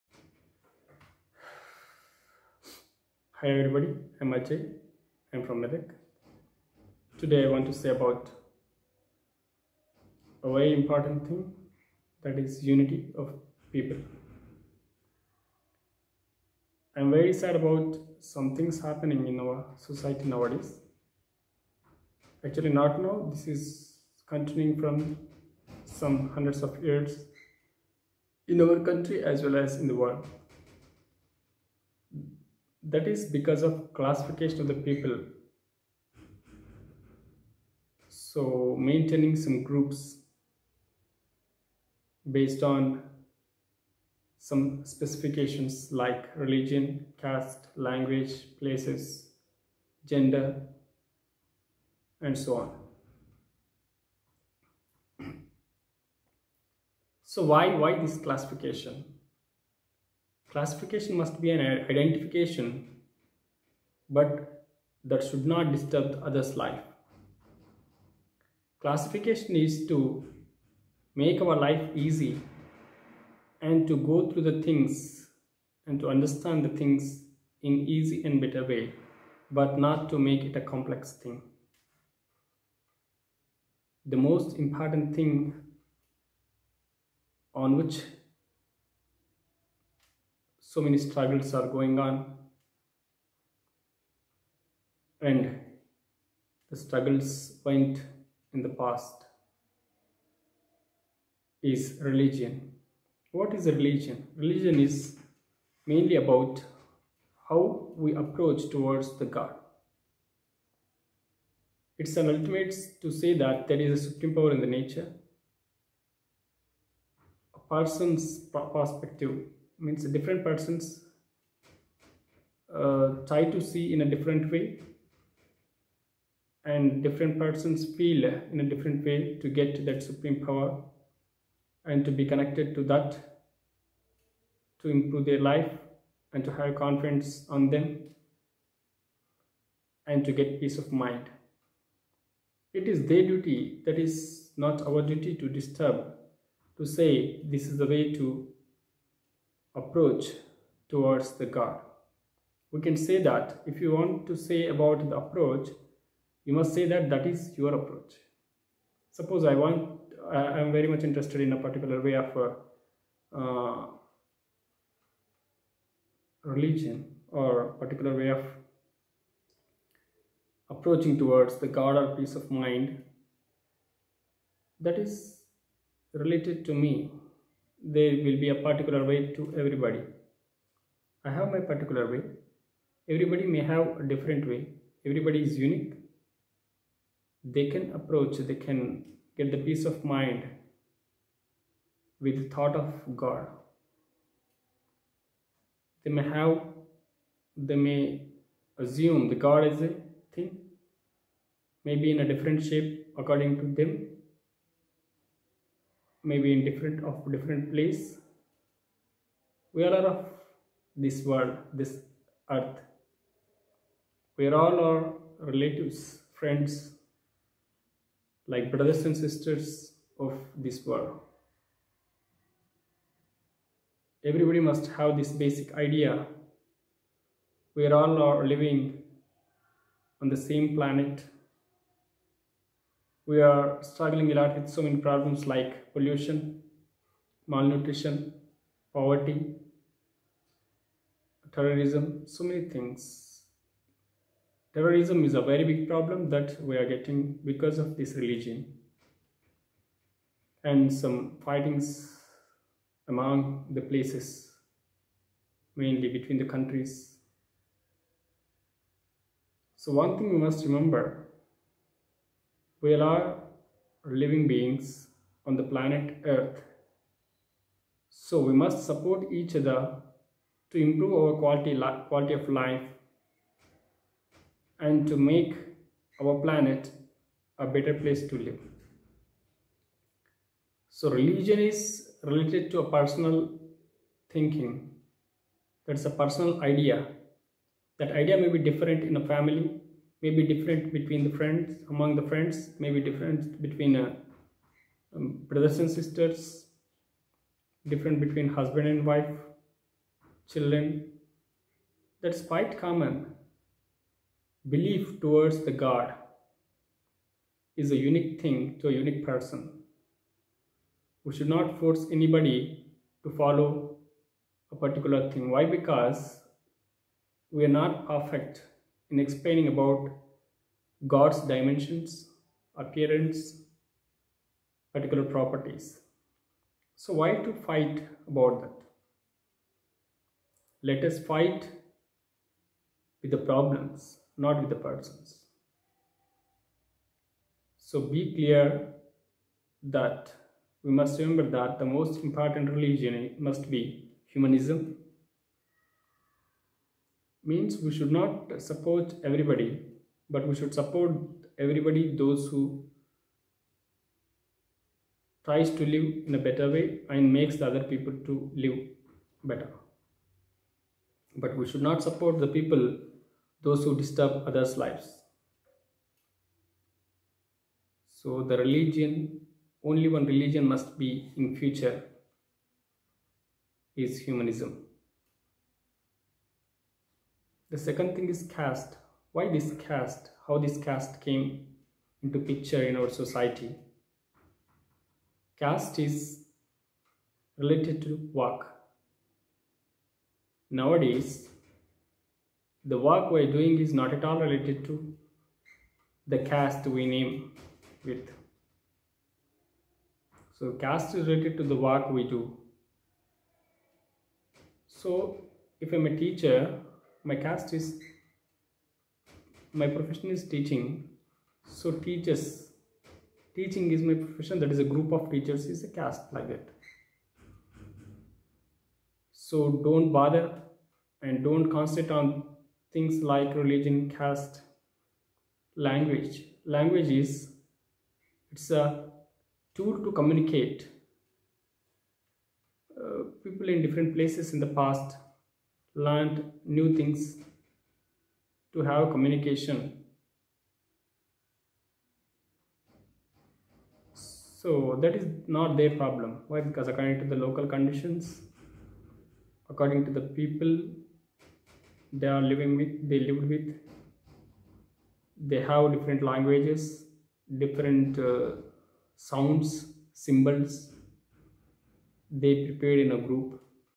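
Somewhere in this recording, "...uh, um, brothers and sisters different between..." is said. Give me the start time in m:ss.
4:53.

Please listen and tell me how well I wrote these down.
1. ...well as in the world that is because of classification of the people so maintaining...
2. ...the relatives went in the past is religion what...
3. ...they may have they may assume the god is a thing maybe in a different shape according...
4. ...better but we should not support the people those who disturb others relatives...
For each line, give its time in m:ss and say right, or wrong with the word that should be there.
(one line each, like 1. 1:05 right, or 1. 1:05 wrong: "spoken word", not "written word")
1. 0:29 right
2. 1:36 wrong: "struggles", not "relatives"
3. 3:16 right
4. 5:59 wrong: "lives", not "relatives".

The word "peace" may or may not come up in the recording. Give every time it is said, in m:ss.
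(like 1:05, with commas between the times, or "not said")
2:20, 2:52, 3:09.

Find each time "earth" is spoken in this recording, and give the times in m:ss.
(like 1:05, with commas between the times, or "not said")
3:32, 4:26.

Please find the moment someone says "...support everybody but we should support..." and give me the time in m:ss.
5:48.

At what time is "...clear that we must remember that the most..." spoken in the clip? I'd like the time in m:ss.
5:38.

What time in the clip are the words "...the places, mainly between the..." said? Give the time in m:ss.
4:13.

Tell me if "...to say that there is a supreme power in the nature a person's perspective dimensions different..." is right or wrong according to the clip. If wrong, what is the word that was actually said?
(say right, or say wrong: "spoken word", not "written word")
wrong: "means", not "dimensions".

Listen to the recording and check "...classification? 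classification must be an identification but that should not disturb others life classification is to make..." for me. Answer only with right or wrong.
right.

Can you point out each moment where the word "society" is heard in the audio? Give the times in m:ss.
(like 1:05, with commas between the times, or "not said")
0:19, 6:23.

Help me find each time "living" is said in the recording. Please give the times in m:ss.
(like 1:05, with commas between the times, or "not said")
3:48, 4:24, 7:32.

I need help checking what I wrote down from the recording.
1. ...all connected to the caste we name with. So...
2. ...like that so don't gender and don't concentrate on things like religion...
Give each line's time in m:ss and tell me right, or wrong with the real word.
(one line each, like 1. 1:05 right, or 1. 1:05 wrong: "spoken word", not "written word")
1. 6:34 wrong: "related", not "connected"
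2. 6:56 wrong: "bother", not "gender".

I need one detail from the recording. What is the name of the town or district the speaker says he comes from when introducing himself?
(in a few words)
Medak.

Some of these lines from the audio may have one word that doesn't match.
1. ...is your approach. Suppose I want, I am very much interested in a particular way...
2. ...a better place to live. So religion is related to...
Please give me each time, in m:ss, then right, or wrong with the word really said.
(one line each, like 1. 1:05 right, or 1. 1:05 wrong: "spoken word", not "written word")
1. 2:37 right
2. 4:37 right.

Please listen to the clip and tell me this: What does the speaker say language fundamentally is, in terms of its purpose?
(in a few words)
A tool to communicate.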